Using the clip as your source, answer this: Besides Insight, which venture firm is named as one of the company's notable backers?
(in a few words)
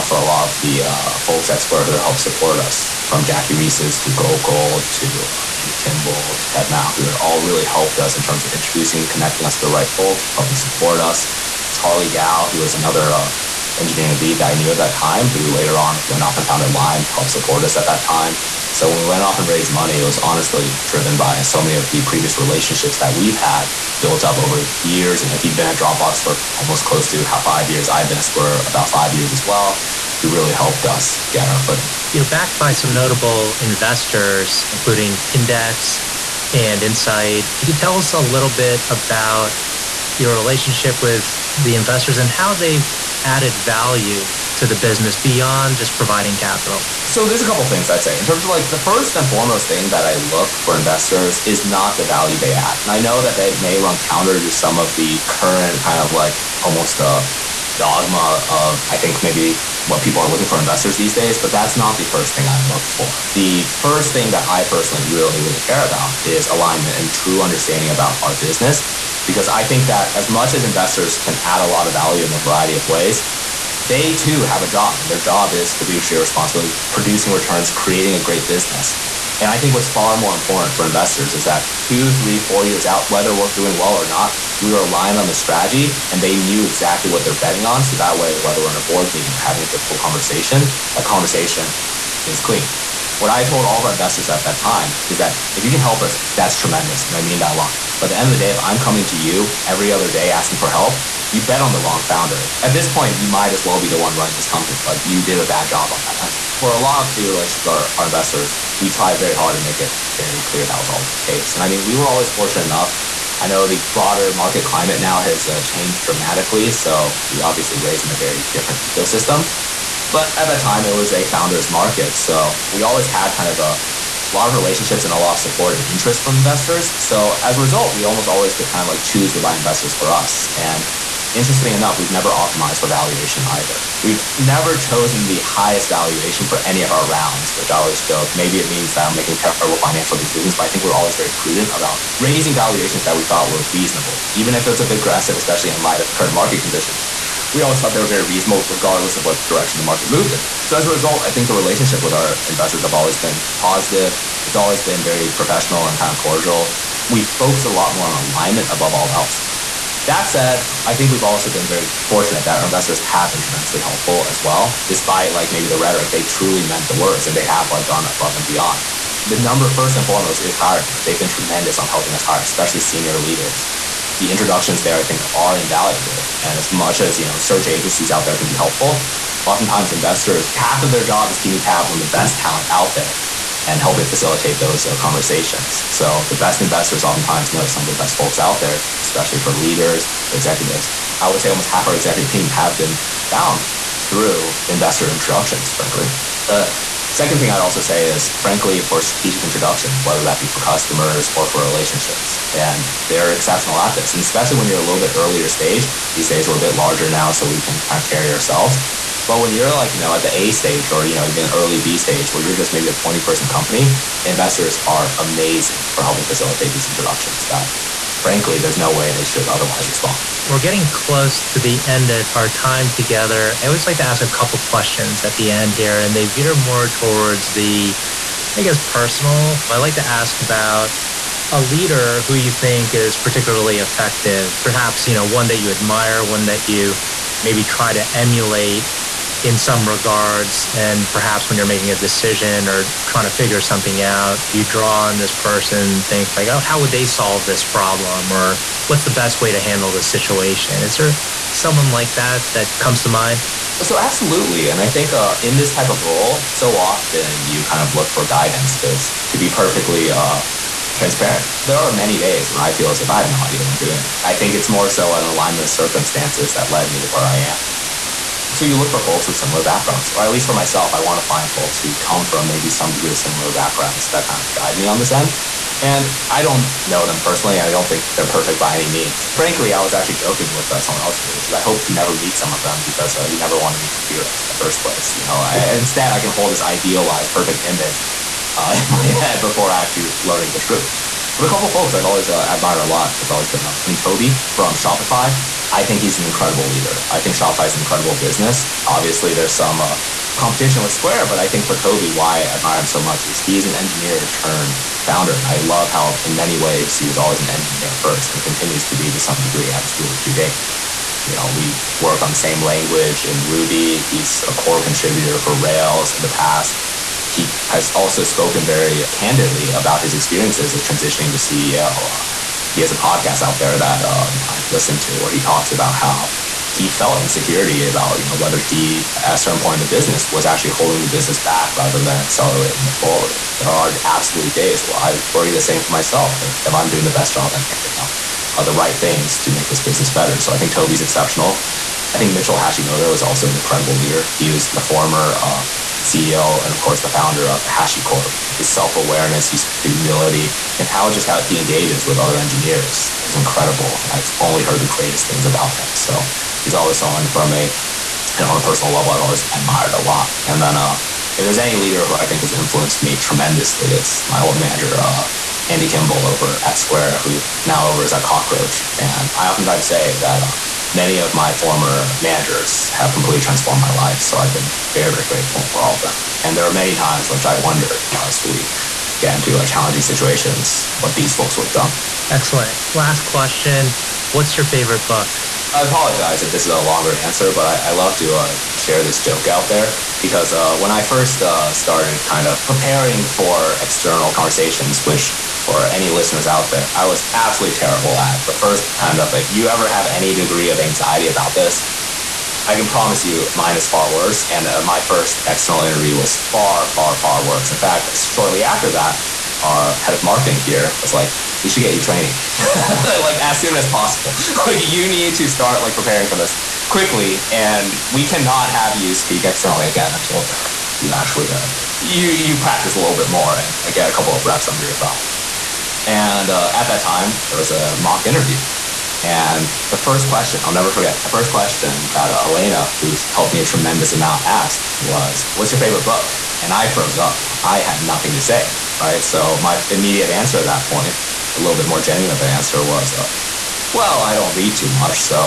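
Index.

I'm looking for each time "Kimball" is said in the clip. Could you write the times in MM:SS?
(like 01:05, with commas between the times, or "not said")
00:05, 06:05.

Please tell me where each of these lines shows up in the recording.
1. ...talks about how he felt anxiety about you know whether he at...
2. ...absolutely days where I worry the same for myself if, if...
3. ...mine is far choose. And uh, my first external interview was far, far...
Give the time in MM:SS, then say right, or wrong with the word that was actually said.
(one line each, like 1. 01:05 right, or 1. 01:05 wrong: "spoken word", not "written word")
1. 05:25 wrong: "insecurity", not "anxiety"
2. 05:34 right
3. 06:43 wrong: "worse", not "choose".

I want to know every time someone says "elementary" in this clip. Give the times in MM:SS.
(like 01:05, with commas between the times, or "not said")
not said.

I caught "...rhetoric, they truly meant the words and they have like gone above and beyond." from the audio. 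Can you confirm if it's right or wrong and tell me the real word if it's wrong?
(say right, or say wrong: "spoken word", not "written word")
right.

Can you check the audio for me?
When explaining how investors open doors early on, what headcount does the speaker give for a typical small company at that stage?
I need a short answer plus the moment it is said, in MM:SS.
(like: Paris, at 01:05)
20, at 03:32.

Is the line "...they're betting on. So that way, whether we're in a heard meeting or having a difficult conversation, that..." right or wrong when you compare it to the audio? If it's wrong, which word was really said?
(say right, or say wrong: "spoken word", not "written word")
wrong: "board", not "heard".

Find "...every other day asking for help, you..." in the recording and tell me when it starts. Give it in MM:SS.
01:39.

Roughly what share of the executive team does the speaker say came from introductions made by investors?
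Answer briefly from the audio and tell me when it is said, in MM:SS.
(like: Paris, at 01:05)
almost half, at 03:11.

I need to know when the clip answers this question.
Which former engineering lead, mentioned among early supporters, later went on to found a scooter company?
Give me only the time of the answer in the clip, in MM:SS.
00:11.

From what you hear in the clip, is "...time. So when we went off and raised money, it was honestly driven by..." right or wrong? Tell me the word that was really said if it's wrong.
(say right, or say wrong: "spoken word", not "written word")
right.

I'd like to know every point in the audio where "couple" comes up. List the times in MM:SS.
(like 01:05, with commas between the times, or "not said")
00:47, 03:44, 04:51, 07:04.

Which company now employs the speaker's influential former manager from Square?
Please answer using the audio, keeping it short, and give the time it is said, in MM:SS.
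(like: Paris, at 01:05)
Cockroach, at 06:08.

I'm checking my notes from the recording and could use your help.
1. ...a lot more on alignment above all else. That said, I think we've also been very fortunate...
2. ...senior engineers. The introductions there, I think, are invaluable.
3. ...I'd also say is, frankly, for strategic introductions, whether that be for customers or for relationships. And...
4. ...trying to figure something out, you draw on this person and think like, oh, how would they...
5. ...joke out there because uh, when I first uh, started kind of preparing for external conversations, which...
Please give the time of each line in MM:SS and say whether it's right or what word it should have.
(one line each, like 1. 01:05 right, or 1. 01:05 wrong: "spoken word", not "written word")
1. 02:37 right
2. 02:52 wrong: "leaders", not "engineers"
3. 03:17 right
4. 04:03 right
5. 06:29 right.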